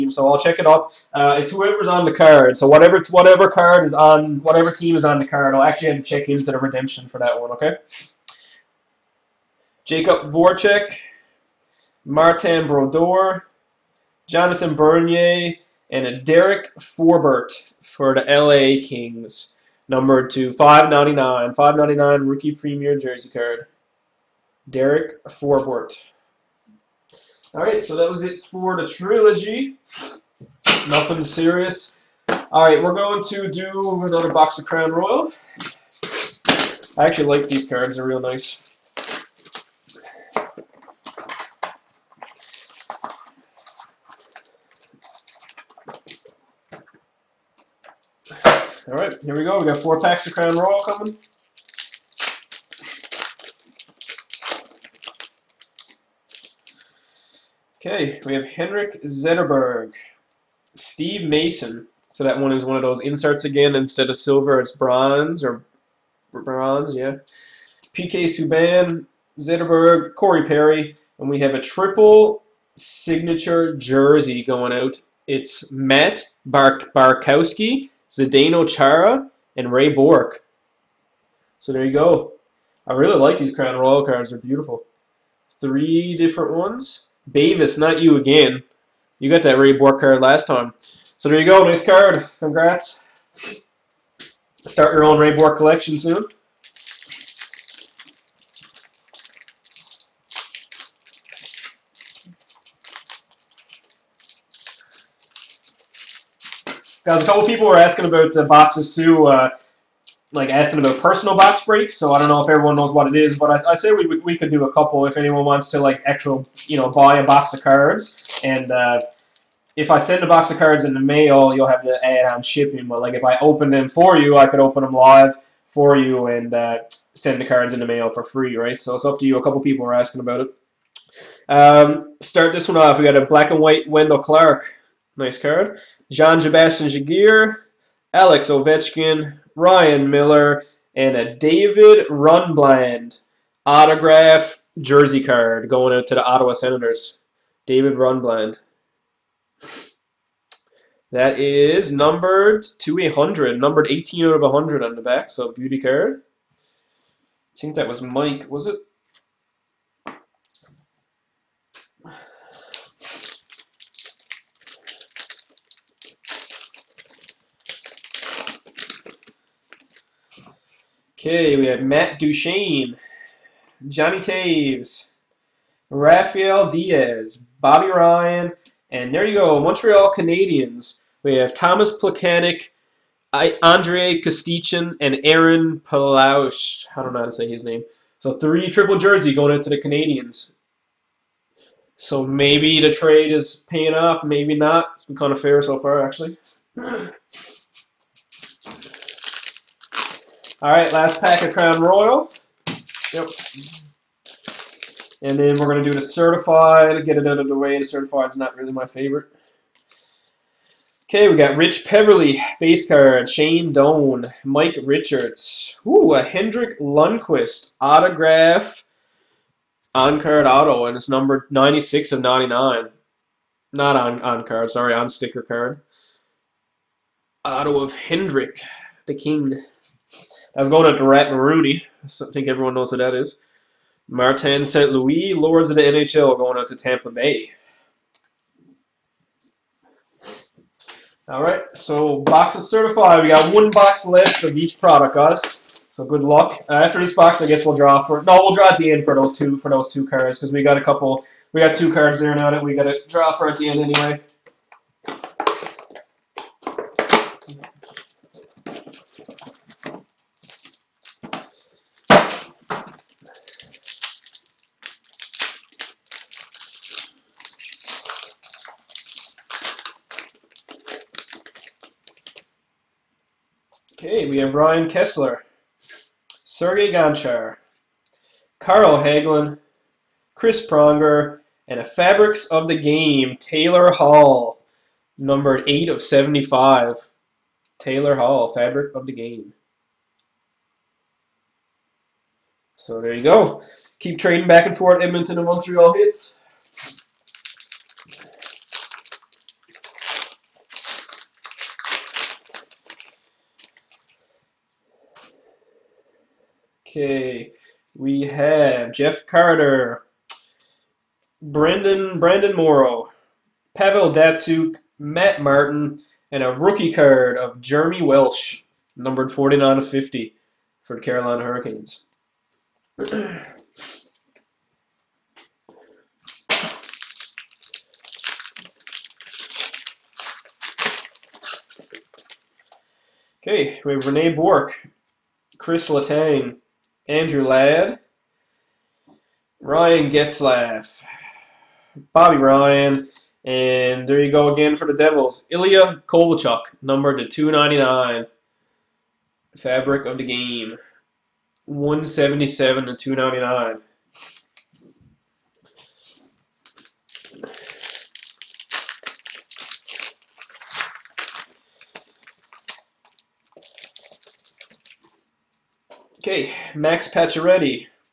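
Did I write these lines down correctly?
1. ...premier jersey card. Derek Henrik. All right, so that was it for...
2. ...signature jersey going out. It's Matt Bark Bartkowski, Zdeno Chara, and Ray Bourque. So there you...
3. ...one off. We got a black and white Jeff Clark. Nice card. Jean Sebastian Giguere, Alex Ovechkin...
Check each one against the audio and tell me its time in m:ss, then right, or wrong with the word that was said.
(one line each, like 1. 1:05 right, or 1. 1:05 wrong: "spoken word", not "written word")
1. 0:22 wrong: "Forbort", not "Henrik"
2. 1:12 right
3. 2:12 wrong: "Wendell", not "Jeff".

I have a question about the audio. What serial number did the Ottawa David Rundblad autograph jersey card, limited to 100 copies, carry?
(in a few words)
18.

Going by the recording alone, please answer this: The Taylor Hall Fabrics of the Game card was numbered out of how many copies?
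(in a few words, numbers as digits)
75.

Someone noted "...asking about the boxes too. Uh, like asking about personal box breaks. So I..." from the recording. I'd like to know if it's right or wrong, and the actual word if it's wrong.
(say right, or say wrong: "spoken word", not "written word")
right.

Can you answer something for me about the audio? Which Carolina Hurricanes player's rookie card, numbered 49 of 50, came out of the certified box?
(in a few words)
Jeremy Welsh.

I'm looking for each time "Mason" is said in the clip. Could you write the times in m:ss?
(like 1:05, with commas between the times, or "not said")
1:01.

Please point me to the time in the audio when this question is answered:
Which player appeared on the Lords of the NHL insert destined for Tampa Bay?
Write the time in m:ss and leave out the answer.
3:54.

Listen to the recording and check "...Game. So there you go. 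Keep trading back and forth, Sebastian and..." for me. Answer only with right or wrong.
wrong.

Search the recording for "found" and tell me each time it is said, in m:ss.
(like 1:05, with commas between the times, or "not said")
not said.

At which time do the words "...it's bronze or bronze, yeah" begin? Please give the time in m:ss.
1:04.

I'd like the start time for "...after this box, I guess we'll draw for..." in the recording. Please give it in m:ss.
4:06.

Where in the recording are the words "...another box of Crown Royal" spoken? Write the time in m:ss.
0:34.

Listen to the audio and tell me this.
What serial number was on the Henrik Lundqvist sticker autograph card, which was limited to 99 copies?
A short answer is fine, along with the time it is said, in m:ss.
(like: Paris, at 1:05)
96, at 3:41.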